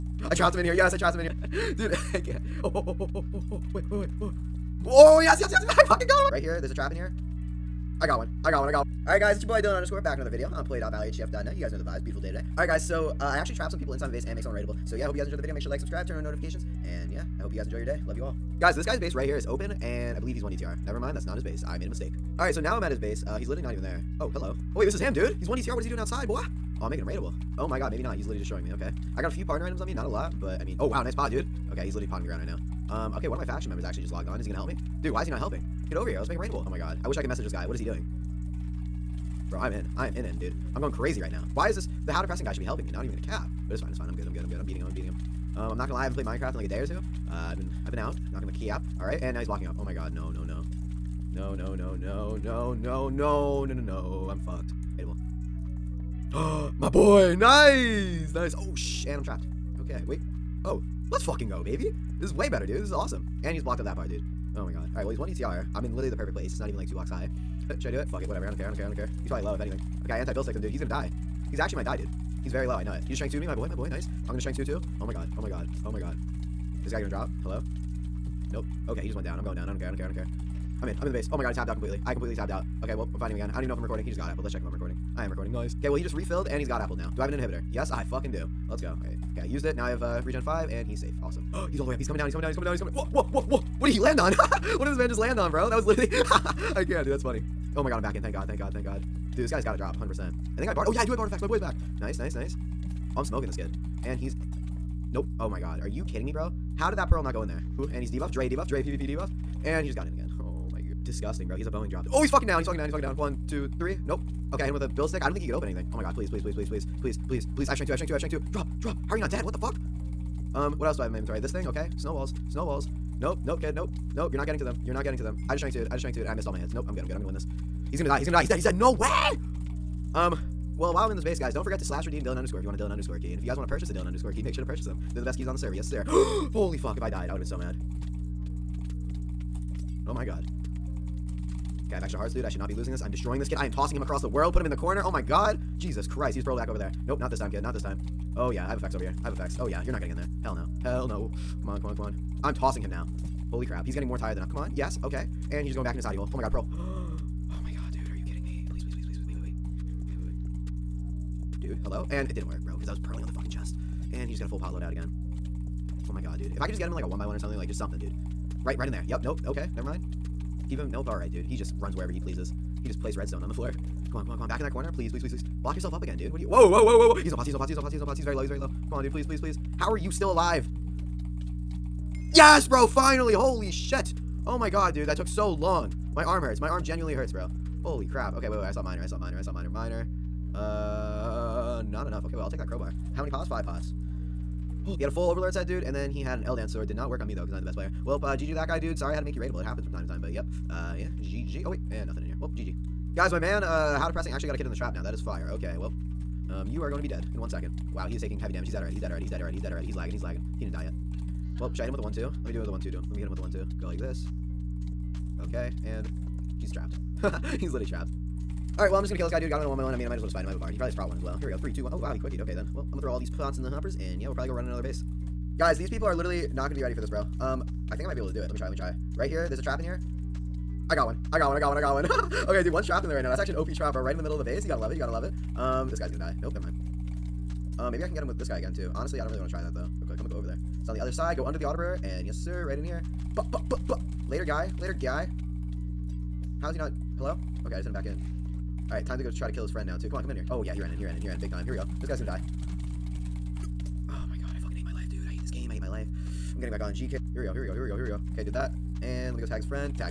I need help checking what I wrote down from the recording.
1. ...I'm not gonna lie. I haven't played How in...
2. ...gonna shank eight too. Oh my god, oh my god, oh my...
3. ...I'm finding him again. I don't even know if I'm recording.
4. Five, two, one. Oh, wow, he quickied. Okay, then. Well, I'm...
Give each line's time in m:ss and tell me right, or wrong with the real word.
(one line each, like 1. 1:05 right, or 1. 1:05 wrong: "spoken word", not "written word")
1. 0:45 wrong: "Minecraft", not "How"
2. 1:14 wrong: "two", not "eight"
3. 1:23 right
4. 3:41 wrong: "Three", not "Five".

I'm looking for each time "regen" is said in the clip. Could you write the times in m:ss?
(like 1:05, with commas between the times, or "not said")
1:30.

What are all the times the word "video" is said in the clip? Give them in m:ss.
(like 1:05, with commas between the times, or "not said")
0:10, 0:15.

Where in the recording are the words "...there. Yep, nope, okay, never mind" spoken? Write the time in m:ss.
2:48.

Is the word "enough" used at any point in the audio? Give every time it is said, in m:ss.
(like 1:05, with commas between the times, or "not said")
3:12.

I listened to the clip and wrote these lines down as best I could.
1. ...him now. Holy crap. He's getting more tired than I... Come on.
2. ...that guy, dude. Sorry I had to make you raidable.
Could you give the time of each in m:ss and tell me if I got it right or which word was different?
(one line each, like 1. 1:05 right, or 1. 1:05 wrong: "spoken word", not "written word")
1. 2:32 right
2. 3:18 right.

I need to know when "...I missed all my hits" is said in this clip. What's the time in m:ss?
2:06.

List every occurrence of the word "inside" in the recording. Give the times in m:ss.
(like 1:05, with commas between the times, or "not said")
0:13.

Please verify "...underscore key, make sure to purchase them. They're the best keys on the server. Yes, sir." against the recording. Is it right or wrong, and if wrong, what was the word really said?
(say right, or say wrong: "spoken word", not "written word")
right.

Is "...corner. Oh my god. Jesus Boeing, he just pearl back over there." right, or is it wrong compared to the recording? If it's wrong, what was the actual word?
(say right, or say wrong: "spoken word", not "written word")
wrong: "Christ", not "Boeing".